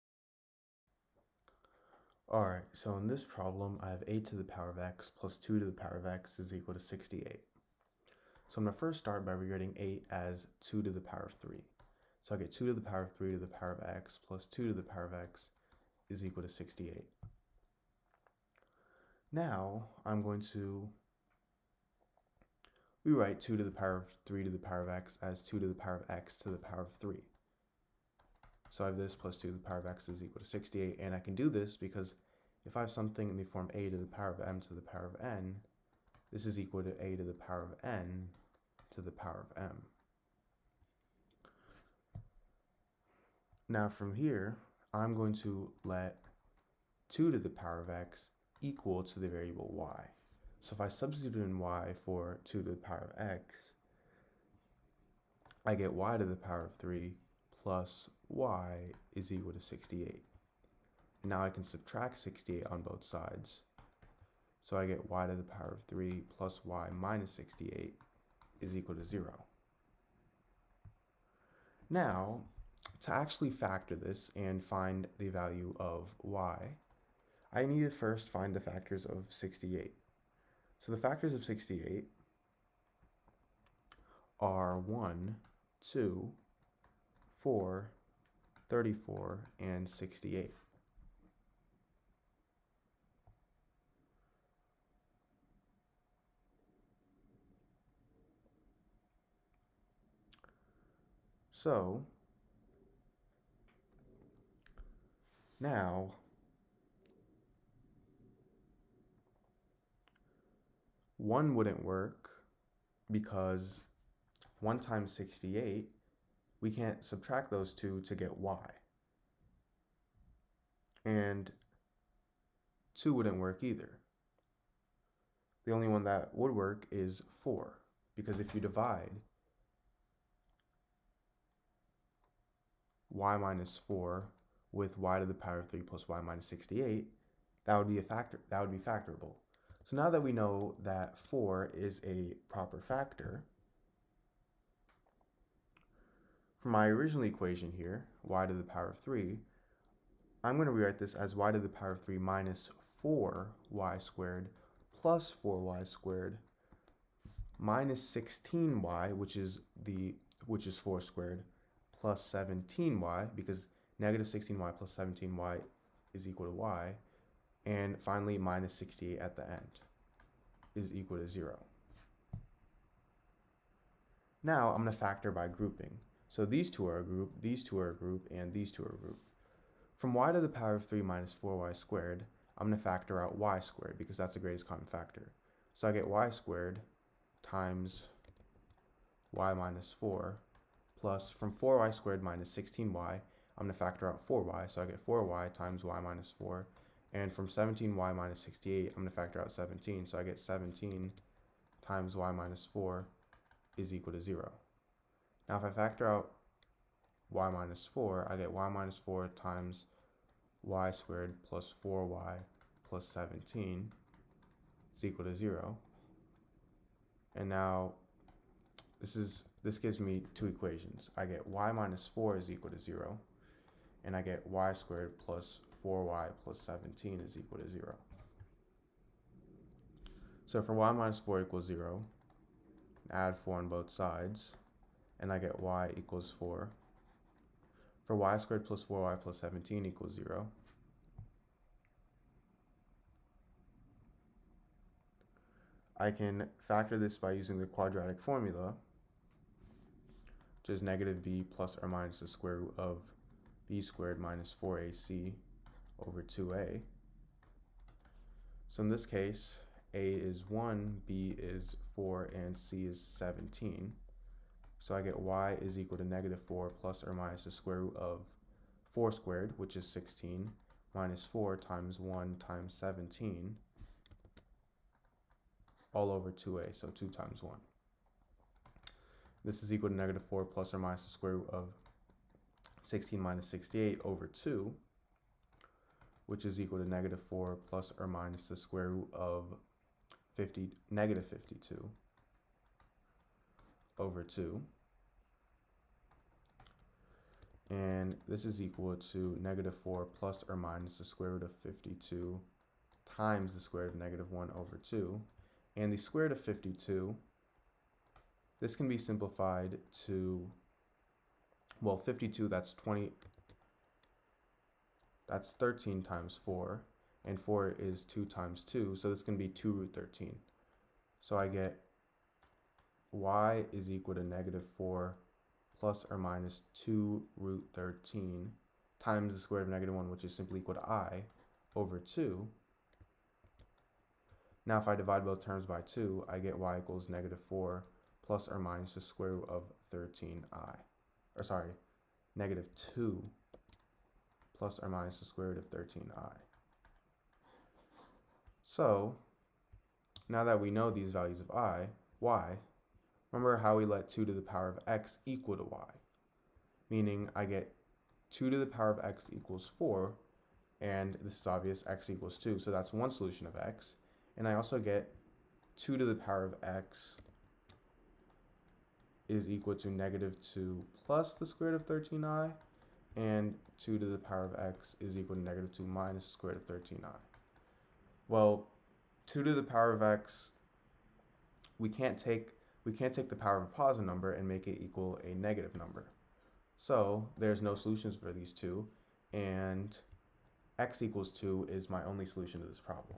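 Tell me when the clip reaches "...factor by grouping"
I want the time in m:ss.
2:54.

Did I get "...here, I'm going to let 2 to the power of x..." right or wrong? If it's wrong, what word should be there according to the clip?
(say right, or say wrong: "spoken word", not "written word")
right.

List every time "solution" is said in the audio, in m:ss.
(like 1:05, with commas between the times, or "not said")
6:03, 6:27, 6:32.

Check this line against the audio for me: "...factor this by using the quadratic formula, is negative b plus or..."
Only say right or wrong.
right.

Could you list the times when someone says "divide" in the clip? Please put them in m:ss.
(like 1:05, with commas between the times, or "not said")
2:08, 5:34.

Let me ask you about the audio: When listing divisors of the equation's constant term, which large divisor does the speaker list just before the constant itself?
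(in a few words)
34.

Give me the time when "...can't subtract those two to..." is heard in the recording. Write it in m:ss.
1:56.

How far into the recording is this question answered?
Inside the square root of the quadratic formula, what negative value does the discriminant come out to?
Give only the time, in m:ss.
4:50.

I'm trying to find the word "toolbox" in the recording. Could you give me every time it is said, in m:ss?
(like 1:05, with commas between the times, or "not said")
not said.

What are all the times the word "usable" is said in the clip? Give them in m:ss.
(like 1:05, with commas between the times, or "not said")
not said.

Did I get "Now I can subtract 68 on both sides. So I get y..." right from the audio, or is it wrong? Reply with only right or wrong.
right.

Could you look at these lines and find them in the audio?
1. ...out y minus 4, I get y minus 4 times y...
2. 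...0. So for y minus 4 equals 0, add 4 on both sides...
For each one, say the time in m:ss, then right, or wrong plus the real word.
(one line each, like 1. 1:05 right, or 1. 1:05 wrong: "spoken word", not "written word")
1. 3:26 right
2. 3:47 right.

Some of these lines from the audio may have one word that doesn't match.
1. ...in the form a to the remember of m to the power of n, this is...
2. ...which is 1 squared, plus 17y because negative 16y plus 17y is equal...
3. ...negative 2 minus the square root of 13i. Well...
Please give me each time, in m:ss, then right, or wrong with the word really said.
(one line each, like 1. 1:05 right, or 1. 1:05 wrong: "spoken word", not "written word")
1. 0:33 wrong: "power", not "remember"
2. 2:40 wrong: "4", not "1"
3. 6:15 right.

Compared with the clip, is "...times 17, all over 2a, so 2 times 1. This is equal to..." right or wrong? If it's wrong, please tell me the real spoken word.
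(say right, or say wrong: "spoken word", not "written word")
right.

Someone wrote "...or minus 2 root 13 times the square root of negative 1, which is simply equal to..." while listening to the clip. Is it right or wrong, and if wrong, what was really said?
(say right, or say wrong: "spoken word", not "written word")
right.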